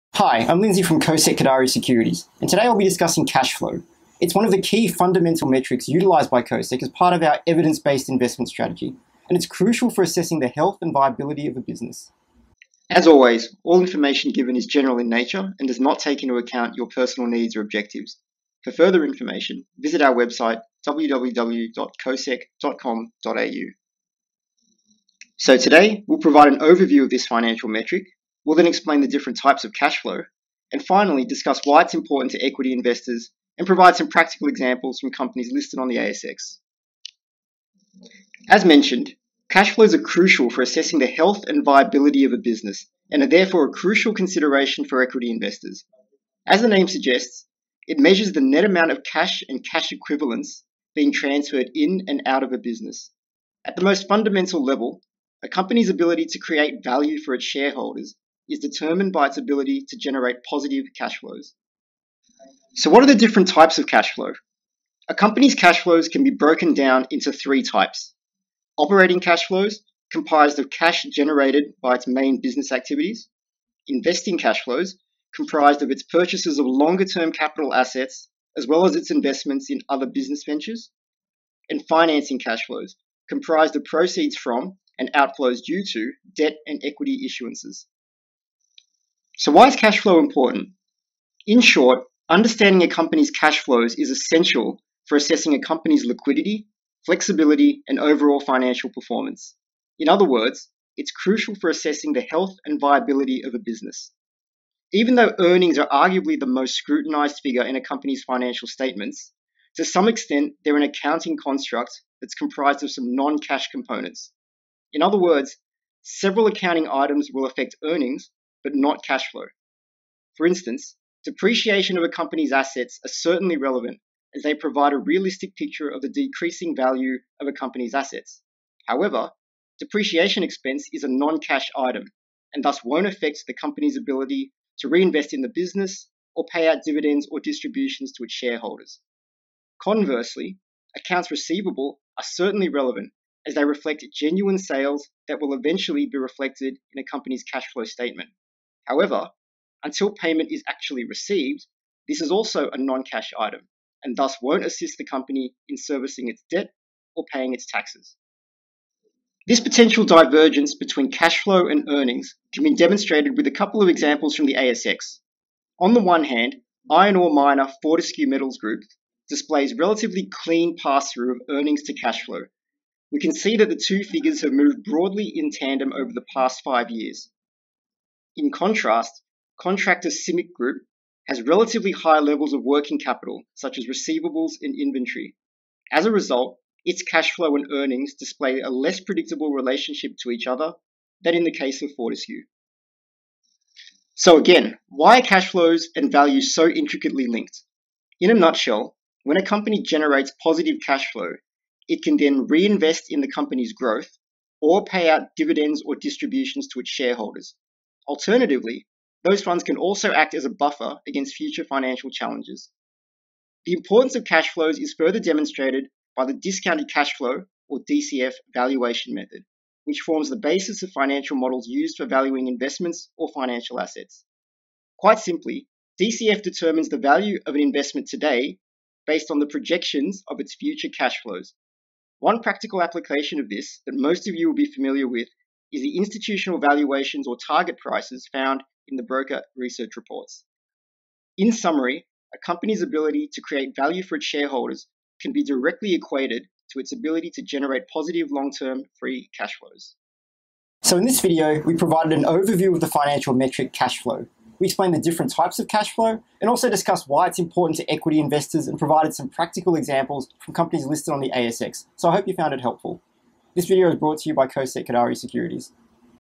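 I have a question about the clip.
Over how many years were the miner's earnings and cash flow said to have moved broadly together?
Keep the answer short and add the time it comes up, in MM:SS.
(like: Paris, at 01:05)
5 years, at 02:56.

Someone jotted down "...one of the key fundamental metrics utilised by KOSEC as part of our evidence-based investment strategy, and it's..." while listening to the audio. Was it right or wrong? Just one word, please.
right.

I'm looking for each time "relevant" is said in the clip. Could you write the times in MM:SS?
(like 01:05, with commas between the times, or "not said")
02:03, 02:22.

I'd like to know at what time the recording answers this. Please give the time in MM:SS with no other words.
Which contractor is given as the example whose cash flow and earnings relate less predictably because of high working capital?
03:00.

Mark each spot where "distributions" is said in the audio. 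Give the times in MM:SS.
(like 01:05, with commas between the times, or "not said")
02:17, 03:25.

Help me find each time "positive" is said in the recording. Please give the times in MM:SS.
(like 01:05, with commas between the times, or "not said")
01:00, 03:20, 04:07.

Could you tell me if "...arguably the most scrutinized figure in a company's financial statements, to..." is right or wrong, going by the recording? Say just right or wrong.
right.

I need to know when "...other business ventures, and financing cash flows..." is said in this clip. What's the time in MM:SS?
01:19.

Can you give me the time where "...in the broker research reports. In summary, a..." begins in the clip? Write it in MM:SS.
03:58.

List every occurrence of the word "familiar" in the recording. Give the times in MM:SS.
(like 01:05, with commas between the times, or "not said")
03:54.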